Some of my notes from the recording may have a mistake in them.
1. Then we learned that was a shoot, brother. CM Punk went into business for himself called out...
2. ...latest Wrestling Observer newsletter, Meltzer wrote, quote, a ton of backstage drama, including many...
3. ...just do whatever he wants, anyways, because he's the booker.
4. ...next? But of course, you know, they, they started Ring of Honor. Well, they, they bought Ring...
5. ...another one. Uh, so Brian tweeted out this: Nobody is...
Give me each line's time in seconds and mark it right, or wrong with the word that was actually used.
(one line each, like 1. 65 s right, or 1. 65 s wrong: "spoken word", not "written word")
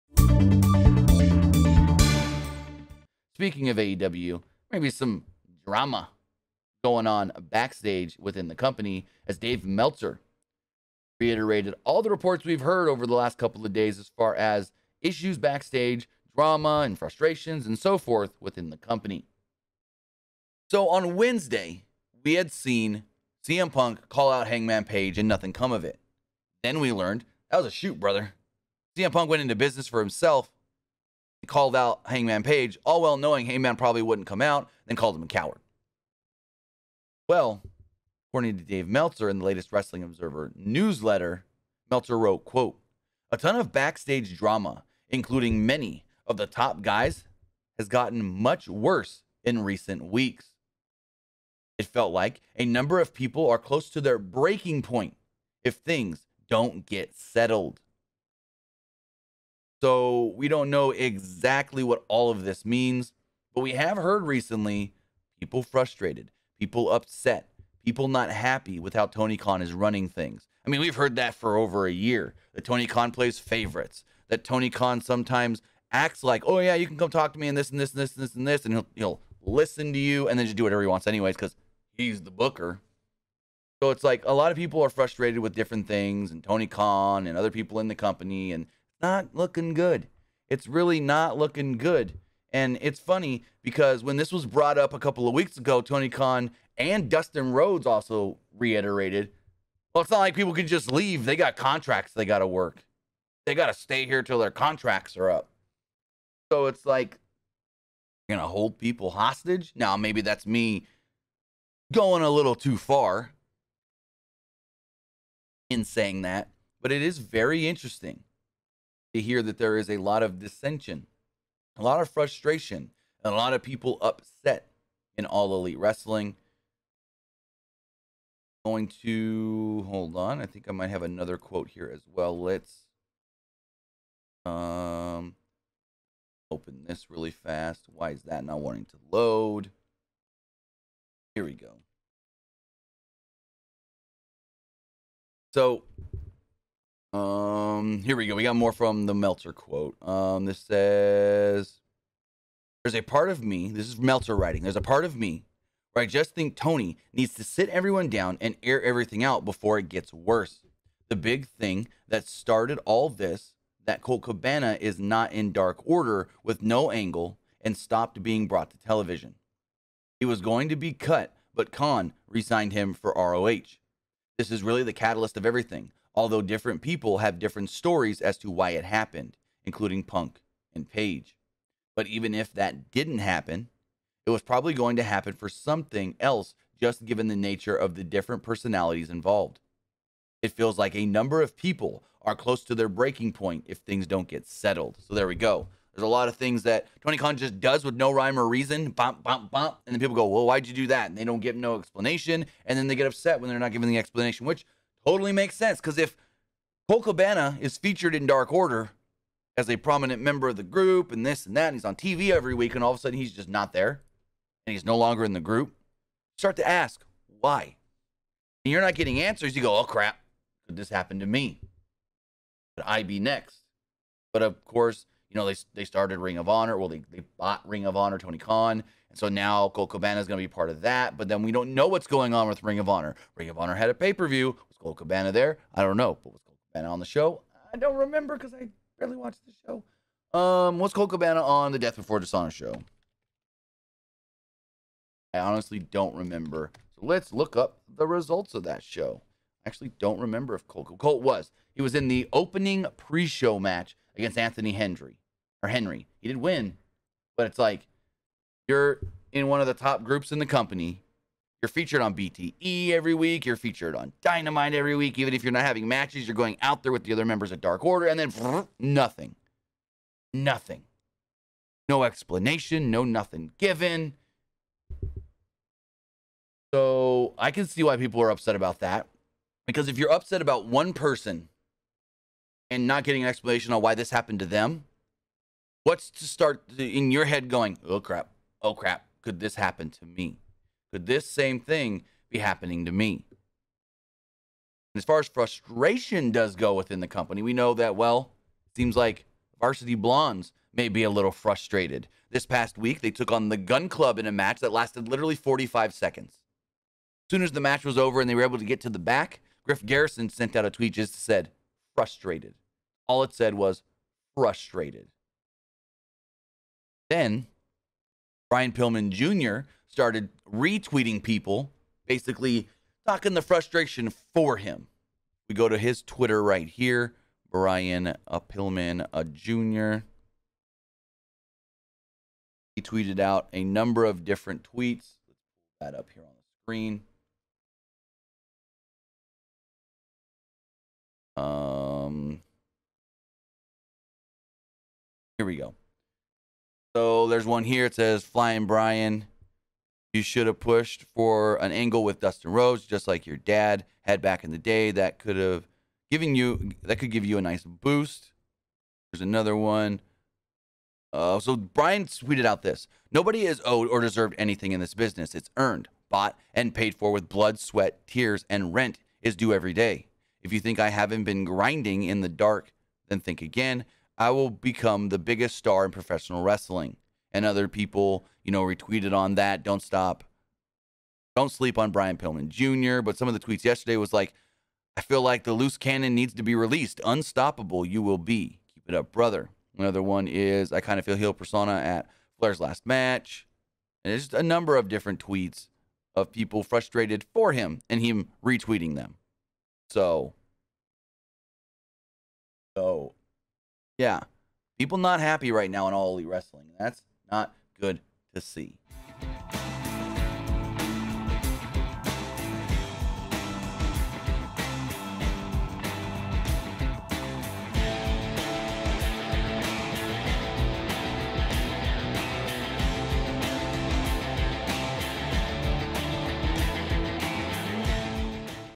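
1. 26 s right
2. 39 s right
3. 80 s right
4. 223 s right
5. 359 s right.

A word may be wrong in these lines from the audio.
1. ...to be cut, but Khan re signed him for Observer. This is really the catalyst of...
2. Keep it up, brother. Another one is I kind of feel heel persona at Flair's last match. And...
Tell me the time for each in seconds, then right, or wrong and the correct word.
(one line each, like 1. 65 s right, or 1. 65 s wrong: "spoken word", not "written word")
1. 170 s wrong: "ROH", not "Observer"
2. 388 s right.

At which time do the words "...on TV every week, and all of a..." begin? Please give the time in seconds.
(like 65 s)
211 s.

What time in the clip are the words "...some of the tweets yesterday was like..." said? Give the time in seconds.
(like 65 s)
383 s.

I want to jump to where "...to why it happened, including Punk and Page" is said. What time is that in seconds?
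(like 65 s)
178 s.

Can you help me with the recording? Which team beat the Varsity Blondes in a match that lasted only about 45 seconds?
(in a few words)
The Gunn Club.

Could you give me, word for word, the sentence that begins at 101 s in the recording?
They got contracts they got to work, they got to stay here till their contracts are up.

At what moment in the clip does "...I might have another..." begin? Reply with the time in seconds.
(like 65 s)
130 s.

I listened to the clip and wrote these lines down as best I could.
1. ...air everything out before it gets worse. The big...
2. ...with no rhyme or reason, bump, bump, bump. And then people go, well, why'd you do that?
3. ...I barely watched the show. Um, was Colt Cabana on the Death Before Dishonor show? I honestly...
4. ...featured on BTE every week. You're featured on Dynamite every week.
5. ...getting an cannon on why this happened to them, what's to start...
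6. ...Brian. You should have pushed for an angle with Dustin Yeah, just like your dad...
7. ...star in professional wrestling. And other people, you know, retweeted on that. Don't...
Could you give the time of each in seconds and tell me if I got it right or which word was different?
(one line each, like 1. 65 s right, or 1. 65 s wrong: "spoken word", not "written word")
1. 158 s right
2. 197 s right
3. 238 s right
4. 261 s right
5. 283 s wrong: "explanation", not "cannon"
6. 348 s wrong: "Rhodes", not "Yeah"
7. 375 s right.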